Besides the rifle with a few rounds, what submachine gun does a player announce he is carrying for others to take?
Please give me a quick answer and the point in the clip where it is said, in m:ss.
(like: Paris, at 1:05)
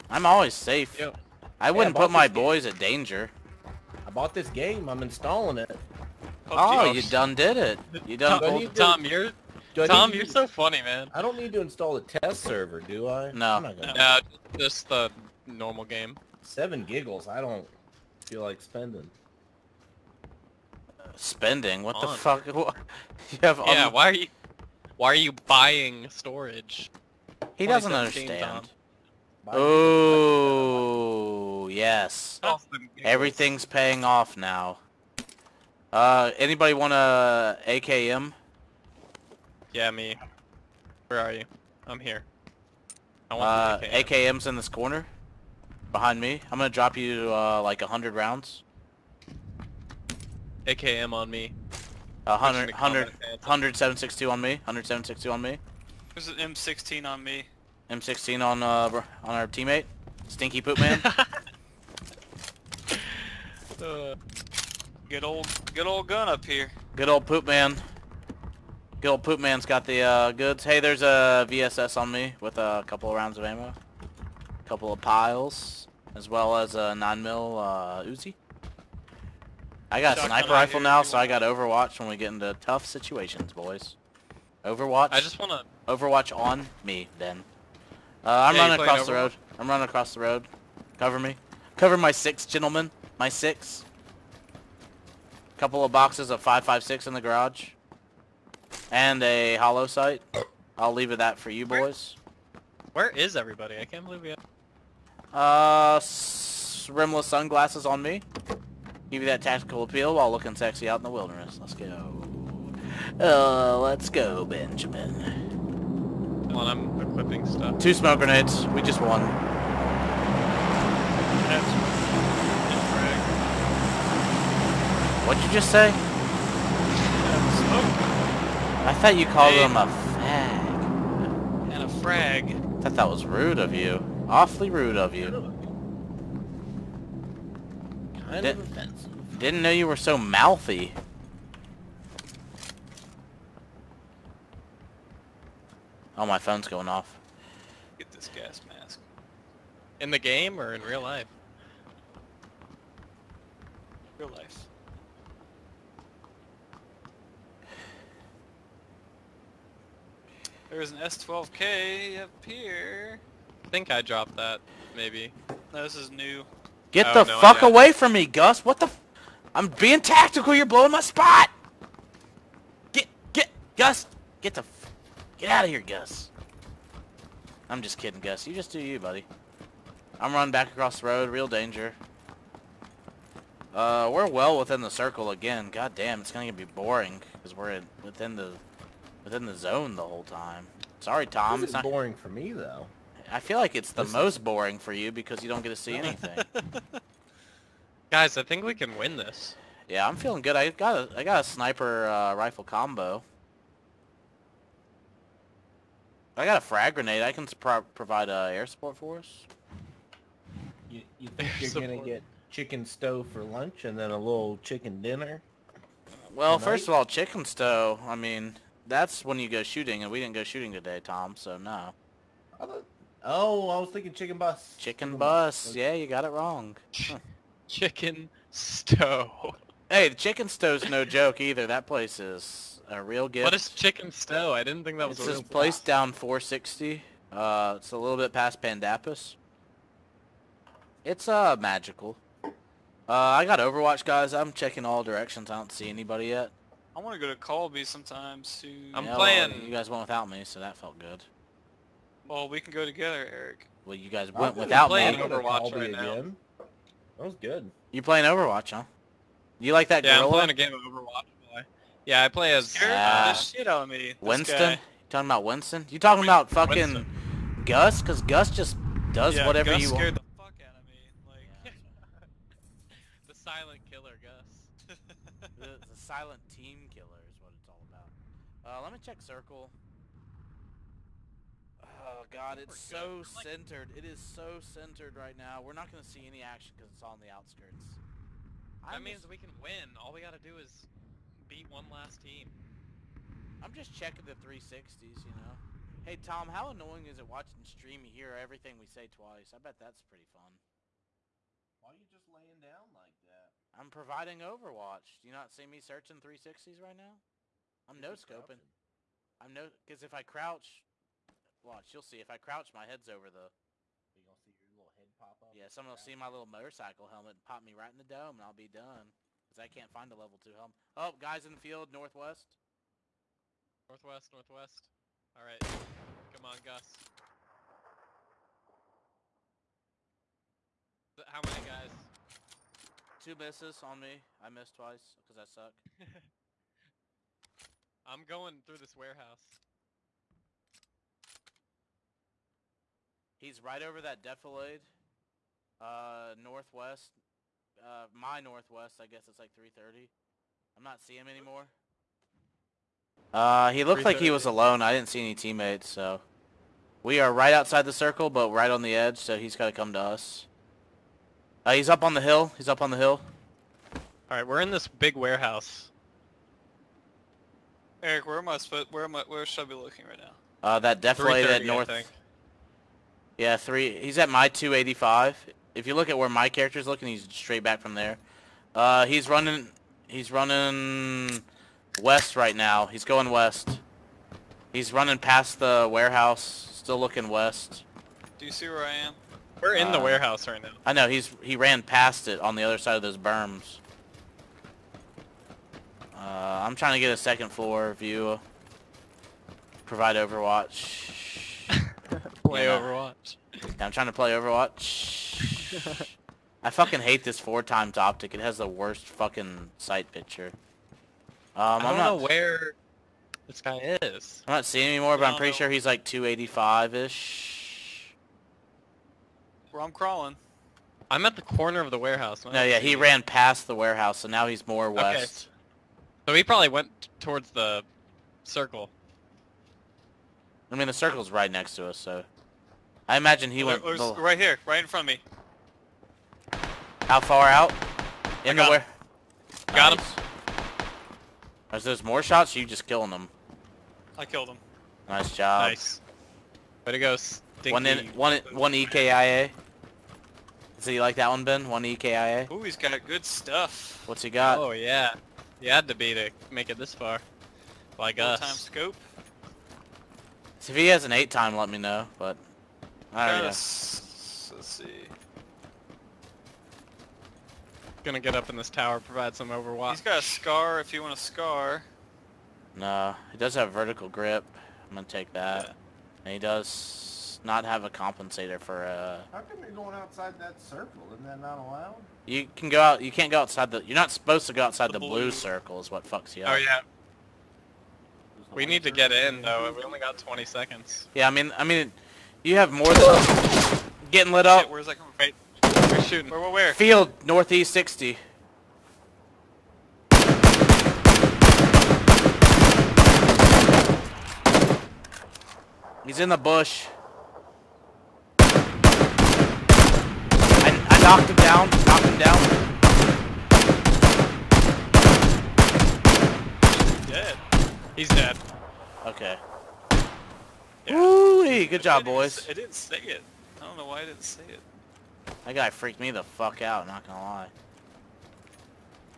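Uzi, at 1:18.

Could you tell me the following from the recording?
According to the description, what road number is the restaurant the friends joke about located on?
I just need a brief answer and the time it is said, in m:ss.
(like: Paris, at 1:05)
460, at 3:56.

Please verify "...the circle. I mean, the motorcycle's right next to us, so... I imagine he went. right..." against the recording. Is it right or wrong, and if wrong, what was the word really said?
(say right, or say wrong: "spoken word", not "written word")
wrong: "circle", not "motorcycle".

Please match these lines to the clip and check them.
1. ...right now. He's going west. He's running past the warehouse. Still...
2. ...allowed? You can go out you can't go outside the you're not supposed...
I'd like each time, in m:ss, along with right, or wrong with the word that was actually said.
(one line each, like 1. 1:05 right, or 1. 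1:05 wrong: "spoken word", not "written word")
1. 6:22 right
2. 8:01 right.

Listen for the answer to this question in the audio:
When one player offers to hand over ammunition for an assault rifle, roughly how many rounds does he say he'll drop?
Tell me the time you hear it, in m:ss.
0:47.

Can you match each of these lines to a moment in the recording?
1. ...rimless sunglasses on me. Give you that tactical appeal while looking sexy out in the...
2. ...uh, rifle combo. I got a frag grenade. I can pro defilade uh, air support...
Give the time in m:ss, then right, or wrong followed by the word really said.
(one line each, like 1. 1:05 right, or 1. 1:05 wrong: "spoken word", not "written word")
1. 1:46 right
2. 3:22 wrong: "provide", not "defilade".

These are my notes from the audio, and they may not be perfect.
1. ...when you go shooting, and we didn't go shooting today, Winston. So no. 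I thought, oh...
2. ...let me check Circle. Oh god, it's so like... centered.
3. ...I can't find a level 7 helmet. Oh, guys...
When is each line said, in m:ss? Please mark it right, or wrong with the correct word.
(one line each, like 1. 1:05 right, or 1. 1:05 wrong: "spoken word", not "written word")
1. 3:39 wrong: "Tom", not "Winston"
2. 4:38 right
3. 5:19 wrong: "2", not "7".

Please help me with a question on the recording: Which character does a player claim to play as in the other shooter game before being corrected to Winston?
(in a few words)
Garrett.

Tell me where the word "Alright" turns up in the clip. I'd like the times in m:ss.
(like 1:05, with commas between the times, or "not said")
5:25, 6:04, 7:43.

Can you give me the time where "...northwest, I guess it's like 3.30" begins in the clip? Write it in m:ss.
5:48.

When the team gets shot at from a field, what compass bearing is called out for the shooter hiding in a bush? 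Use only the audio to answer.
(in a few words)
Northeast 60.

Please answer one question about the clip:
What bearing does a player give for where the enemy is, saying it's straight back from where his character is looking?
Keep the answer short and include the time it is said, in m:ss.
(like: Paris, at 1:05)
285, at 6:14.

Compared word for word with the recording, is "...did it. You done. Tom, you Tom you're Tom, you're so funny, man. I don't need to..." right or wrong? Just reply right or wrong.
right.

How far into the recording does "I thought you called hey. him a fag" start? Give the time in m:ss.
2:08.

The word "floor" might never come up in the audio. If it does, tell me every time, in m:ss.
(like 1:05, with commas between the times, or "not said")
6:37.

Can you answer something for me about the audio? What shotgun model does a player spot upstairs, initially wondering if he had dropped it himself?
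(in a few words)
S12K.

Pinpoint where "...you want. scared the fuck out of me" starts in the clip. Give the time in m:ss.
4:29.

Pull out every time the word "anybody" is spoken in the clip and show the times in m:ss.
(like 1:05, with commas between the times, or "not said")
0:36, 4:05.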